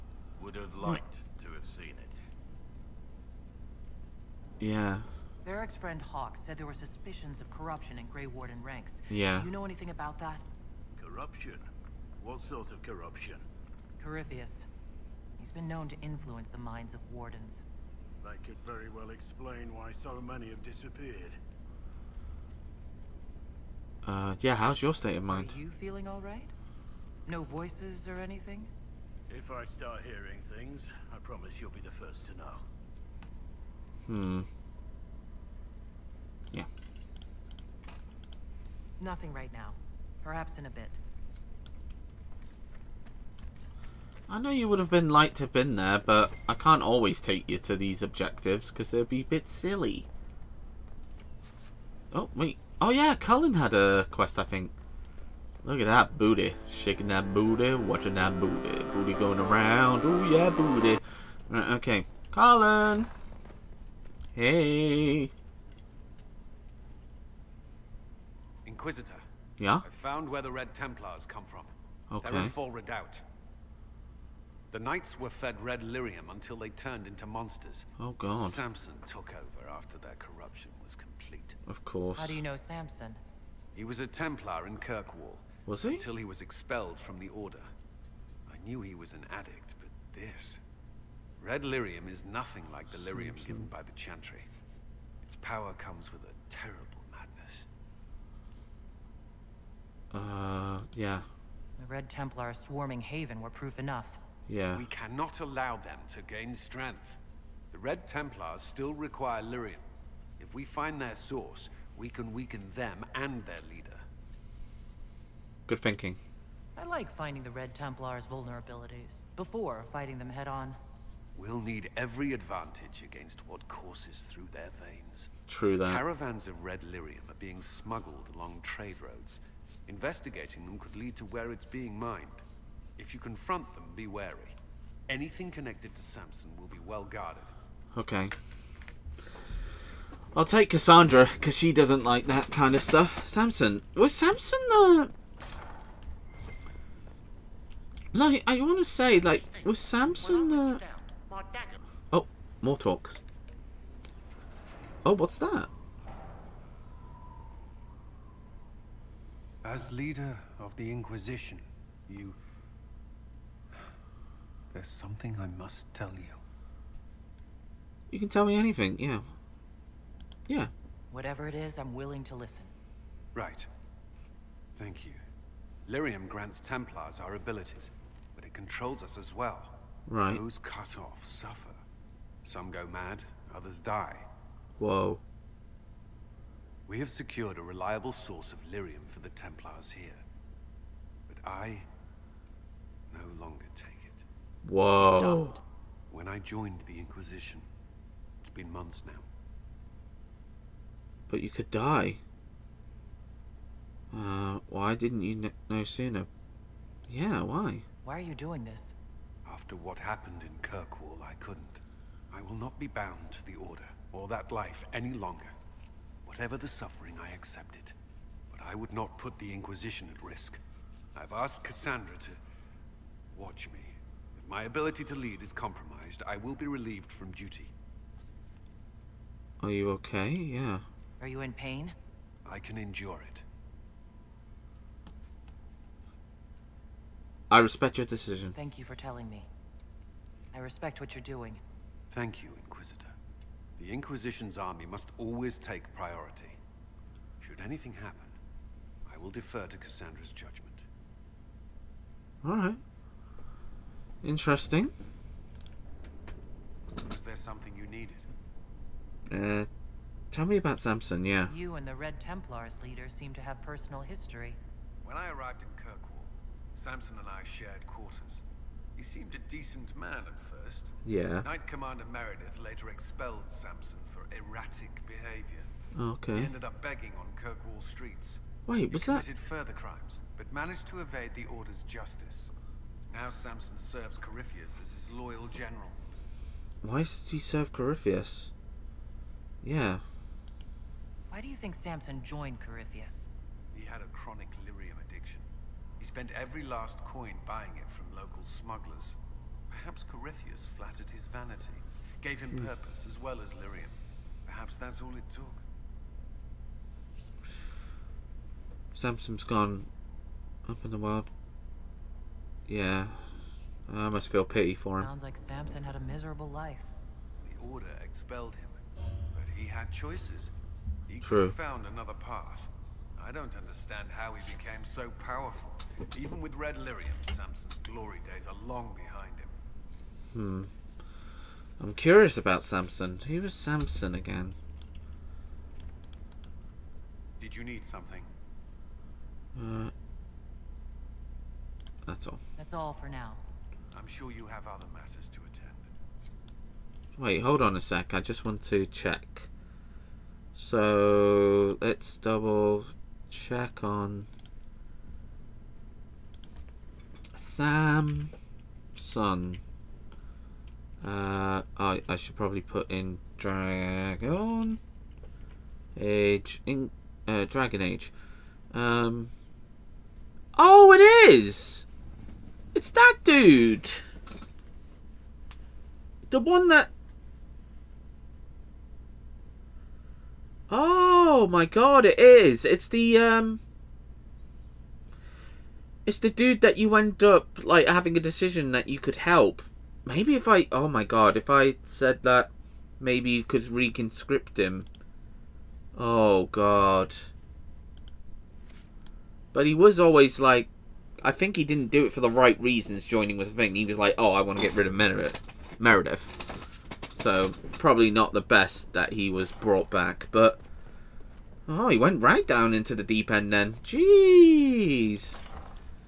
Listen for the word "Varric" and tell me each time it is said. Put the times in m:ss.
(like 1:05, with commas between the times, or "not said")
0:05.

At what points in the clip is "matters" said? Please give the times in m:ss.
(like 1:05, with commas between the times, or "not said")
5:44.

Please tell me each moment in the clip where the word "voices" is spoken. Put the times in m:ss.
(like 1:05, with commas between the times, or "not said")
0:27.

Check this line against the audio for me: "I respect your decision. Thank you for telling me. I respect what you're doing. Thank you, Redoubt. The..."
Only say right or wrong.
wrong.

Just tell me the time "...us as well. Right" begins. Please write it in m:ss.
2:59.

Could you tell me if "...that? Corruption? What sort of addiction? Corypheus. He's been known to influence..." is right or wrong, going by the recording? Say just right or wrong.
wrong.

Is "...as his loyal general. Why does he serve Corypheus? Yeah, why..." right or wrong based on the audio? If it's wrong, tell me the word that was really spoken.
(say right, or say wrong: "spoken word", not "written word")
right.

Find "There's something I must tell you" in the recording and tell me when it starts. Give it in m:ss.
2:44.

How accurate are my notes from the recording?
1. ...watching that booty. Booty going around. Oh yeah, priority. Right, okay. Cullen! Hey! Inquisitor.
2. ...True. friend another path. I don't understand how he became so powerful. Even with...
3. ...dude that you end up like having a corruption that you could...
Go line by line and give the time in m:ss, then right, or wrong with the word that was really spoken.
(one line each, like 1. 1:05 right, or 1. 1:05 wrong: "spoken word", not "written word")
1. 0:57 wrong: "booty", not "priority"
2. 5:21 wrong: "found", not "friend"
3. 6:26 wrong: "decision", not "corruption".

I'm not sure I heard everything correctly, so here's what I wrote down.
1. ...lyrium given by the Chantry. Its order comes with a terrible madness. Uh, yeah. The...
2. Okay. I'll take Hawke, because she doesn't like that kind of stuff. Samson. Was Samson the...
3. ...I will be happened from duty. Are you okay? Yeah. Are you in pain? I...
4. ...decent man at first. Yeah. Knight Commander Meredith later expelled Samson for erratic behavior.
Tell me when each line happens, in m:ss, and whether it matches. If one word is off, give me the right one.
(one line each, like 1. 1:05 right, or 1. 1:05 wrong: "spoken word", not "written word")
1. 1:32 wrong: "power", not "order"
2. 2:17 wrong: "Cassandra", not "Hawke"
3. 3:46 wrong: "relieved", not "happened"
4. 4:29 right.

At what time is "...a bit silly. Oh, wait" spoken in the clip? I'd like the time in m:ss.
0:49.